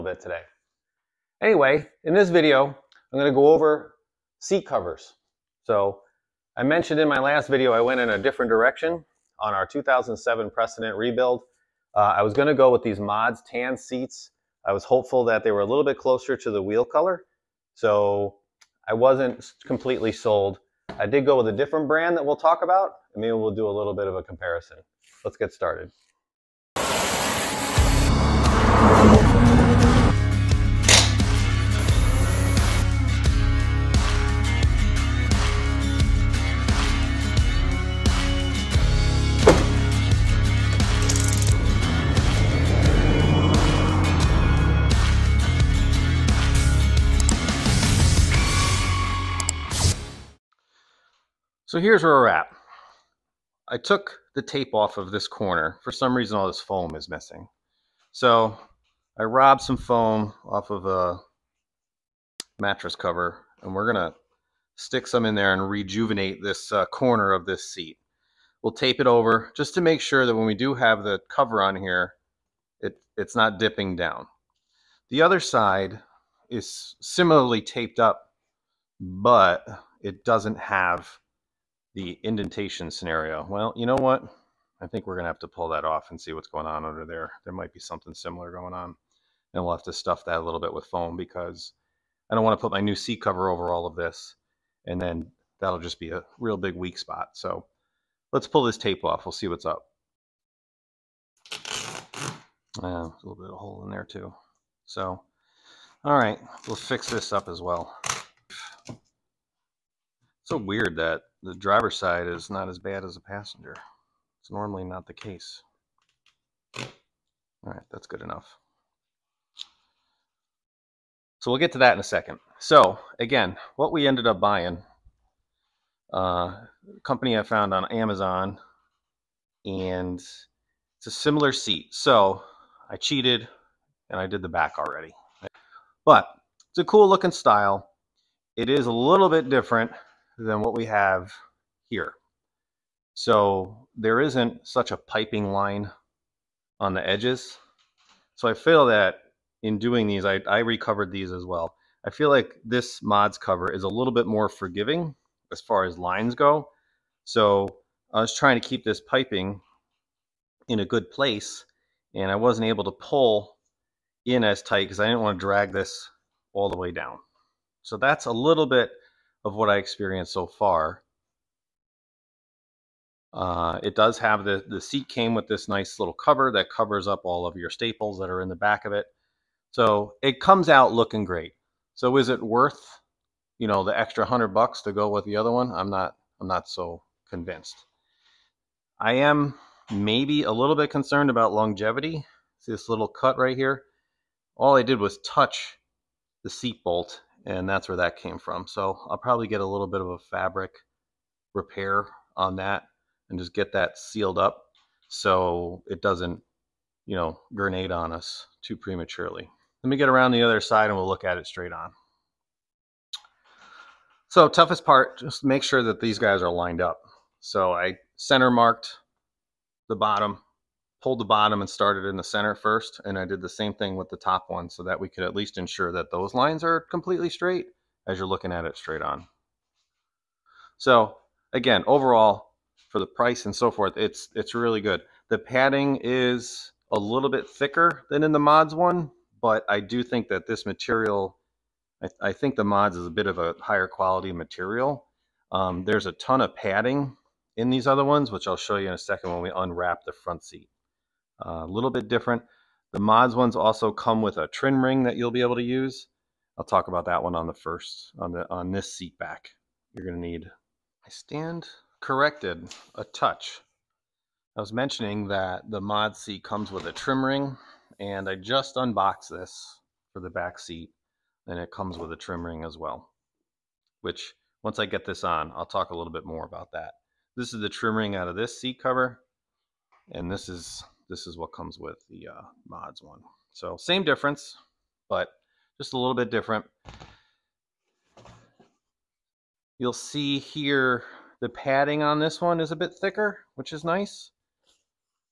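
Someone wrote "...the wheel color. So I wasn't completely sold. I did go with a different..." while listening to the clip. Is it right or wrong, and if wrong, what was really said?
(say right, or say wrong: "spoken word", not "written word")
right.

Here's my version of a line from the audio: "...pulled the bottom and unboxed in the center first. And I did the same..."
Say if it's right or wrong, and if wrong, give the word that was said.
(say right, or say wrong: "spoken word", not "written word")
wrong: "started", not "unboxed".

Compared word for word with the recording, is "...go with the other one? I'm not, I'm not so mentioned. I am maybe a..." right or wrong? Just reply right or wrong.
wrong.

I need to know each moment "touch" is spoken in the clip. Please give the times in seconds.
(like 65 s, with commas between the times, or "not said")
195 s, 263 s.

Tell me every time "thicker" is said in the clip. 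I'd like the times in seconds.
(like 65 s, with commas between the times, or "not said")
237 s, 292 s.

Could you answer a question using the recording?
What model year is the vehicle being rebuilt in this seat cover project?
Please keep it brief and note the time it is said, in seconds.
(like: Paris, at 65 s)
2007, at 9 s.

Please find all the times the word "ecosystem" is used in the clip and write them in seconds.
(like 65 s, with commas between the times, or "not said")
not said.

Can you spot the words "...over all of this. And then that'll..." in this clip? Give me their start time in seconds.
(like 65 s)
93 s.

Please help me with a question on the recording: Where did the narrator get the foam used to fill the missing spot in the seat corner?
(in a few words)
a mattress cover.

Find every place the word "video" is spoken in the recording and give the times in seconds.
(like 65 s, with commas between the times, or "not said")
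2 s, 7 s.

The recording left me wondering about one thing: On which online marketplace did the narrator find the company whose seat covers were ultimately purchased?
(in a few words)
Amazon.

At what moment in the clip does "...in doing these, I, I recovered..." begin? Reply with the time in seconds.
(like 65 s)
149 s.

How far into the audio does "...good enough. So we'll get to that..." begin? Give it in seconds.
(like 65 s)
118 s.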